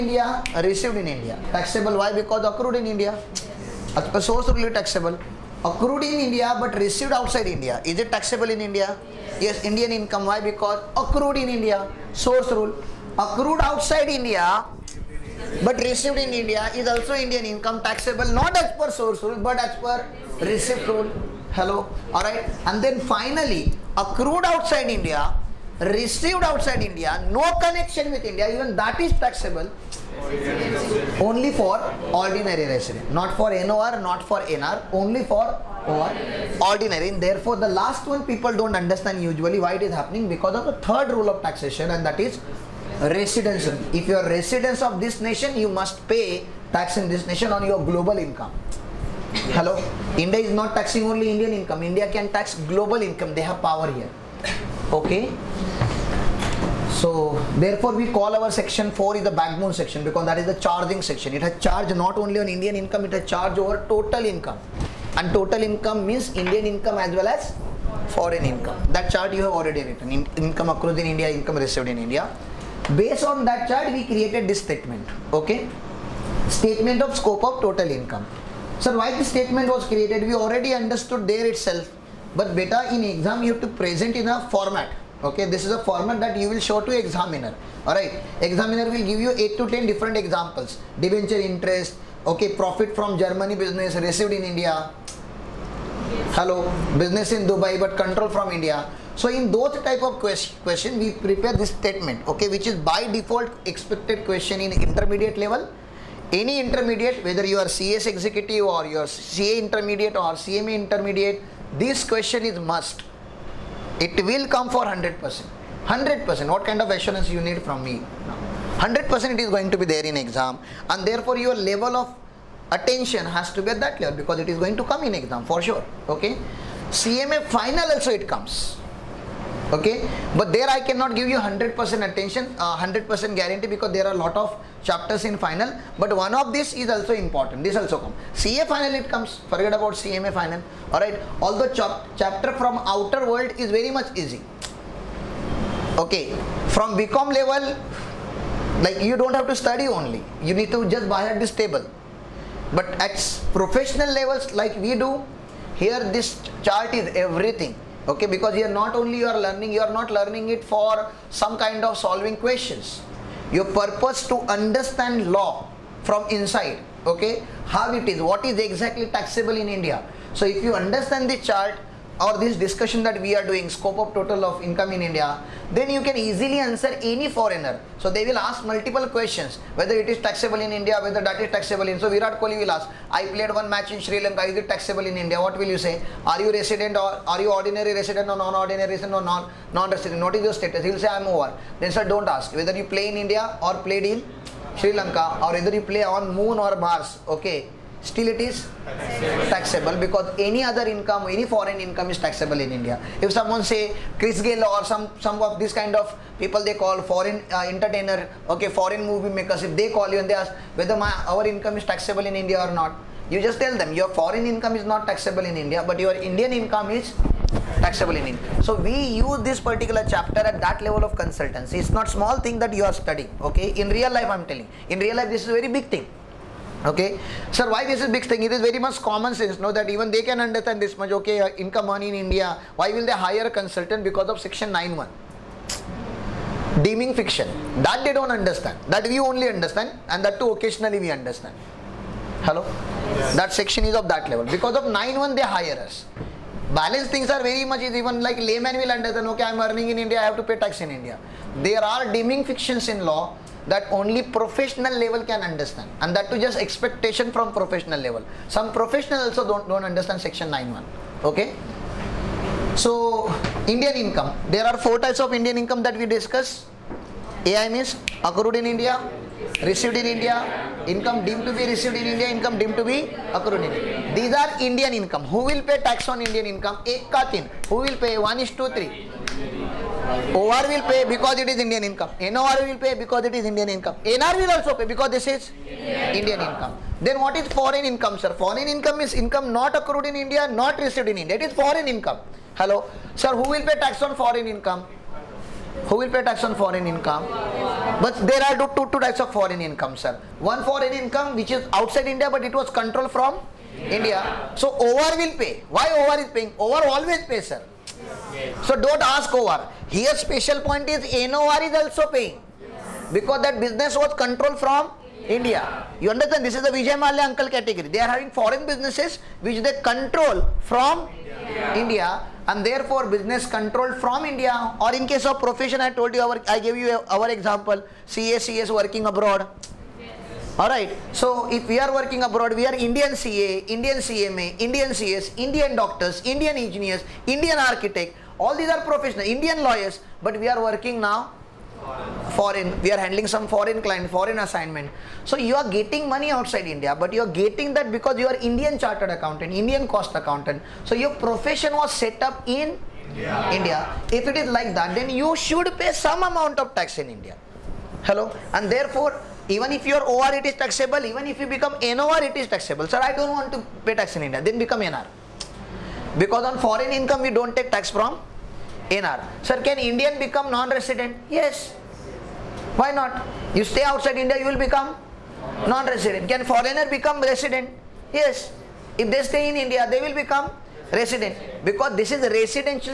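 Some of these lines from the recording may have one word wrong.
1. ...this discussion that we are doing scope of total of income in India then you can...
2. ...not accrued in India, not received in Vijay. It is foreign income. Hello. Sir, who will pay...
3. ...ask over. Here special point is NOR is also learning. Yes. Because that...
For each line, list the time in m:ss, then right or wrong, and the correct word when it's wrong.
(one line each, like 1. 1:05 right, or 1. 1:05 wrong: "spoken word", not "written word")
1. 2:52 right
2. 4:49 wrong: "India", not "Vijay"
3. 5:09 wrong: "paying", not "learning".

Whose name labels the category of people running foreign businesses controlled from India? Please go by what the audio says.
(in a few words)
Vijay Mallya.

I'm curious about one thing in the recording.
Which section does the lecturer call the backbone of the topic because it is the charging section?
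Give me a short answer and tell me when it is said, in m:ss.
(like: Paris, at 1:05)
Section 4, at 0:58.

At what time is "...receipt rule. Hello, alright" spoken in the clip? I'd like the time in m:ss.
0:20.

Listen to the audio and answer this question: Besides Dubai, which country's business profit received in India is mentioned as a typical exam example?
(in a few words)
Germany.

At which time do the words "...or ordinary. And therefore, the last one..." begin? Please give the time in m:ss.
0:35.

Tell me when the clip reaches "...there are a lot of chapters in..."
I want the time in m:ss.
2:13.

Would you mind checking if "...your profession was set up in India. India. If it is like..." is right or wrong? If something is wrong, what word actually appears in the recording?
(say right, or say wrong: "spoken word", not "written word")
right.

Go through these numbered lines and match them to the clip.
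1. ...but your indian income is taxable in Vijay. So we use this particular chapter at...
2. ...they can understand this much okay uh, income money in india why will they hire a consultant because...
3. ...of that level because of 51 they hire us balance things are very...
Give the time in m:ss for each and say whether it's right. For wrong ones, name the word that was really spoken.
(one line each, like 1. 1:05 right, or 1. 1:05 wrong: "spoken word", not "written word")
1. 3:35 wrong: "India", not "Vijay"
2. 3:50 right
3. 4:03 wrong: "91", not "51".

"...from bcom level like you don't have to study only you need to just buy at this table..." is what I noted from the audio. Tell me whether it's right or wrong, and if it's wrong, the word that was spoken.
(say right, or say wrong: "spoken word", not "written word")
right.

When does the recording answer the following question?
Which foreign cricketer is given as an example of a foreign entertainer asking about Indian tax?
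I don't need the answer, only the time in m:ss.
3:24.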